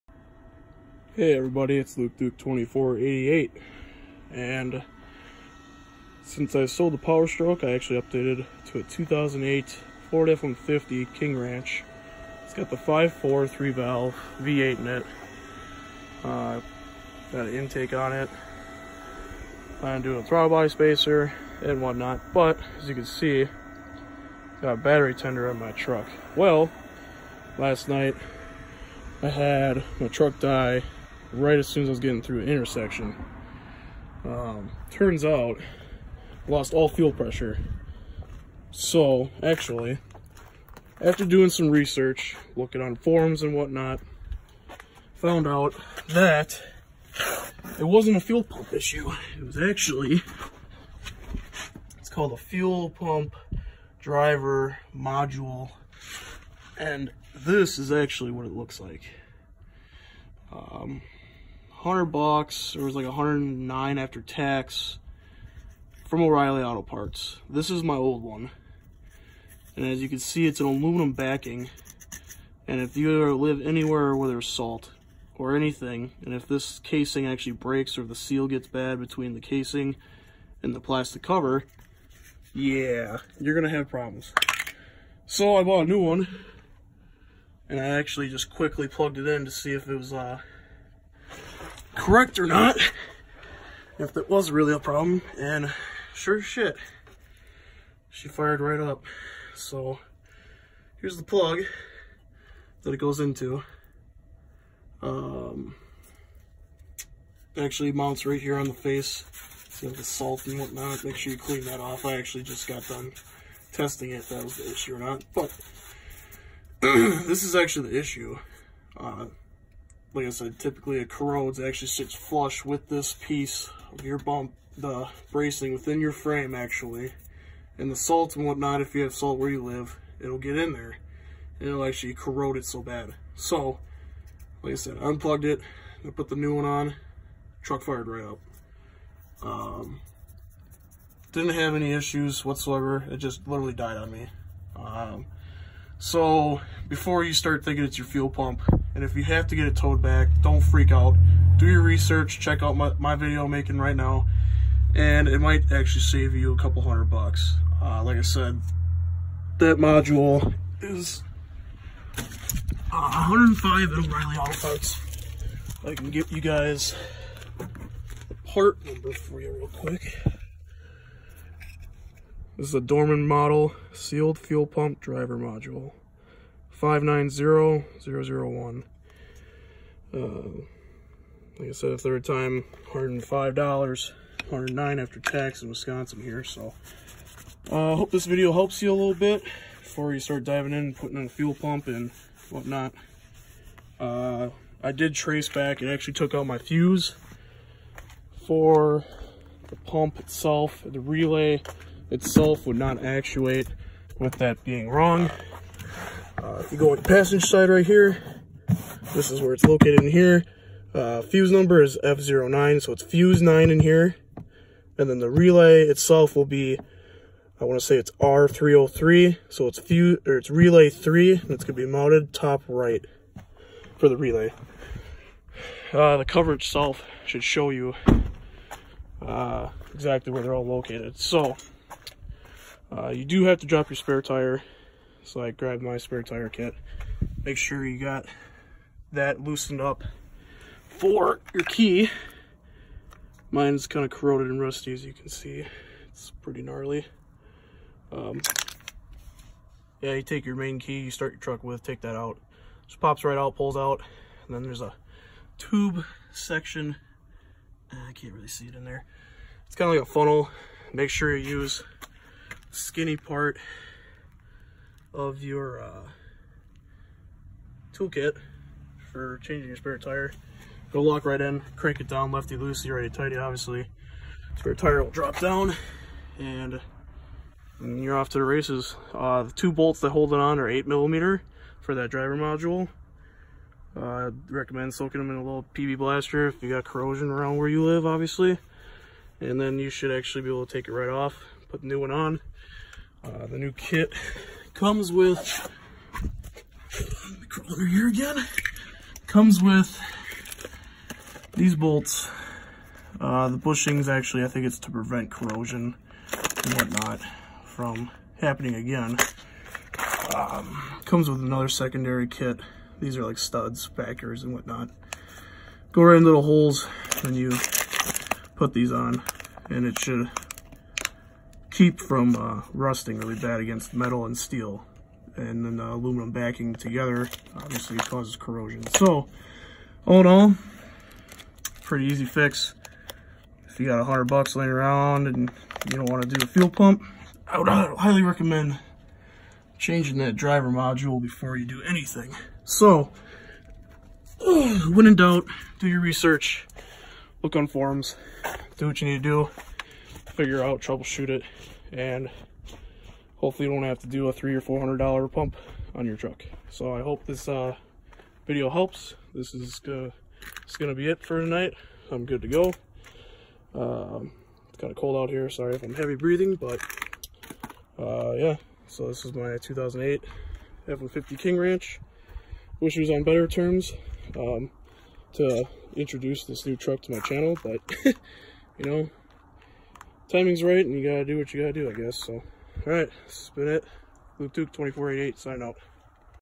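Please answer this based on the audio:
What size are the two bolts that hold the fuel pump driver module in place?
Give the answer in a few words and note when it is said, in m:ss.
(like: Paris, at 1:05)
8 millimeter, at 4:40.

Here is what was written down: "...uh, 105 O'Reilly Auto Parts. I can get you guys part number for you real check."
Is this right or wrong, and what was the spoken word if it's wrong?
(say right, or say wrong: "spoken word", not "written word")
wrong: "quick", not "check".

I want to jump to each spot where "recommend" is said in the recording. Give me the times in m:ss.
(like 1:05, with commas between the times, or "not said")
4:44, 5:38.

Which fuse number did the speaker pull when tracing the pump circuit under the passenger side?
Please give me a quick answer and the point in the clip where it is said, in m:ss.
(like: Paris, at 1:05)
F09, at 3:32.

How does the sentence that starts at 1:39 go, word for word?
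So here's the plug that it goes into.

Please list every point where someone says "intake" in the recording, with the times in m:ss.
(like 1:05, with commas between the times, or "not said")
0:17.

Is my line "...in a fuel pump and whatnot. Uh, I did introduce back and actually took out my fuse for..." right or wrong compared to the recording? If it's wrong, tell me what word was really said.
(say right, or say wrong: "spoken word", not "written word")
wrong: "trace", not "introduce".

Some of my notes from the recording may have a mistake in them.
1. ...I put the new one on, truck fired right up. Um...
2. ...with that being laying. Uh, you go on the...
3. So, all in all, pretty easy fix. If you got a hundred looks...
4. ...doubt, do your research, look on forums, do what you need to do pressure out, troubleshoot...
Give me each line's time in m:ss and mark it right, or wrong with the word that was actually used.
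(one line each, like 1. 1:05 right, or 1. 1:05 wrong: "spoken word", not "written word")
1. 2:16 right
2. 3:24 wrong: "wrong", not "laying"
3. 5:28 wrong: "bucks", not "looks"
4. 5:45 wrong: "figure", not "pressure".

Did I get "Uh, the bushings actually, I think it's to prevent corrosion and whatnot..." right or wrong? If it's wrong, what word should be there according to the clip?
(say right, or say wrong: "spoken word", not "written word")
right.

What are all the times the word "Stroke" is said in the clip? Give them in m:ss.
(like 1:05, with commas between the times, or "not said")
0:07.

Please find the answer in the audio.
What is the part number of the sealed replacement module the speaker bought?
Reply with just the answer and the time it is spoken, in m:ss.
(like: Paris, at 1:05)
590001, at 2:56.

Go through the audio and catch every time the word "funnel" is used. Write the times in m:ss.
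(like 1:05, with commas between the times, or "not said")
4:20.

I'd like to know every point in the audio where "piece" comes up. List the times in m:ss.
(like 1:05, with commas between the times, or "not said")
2:03.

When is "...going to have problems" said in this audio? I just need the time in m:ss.
1:23.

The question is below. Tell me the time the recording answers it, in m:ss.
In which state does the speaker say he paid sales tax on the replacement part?
3:05.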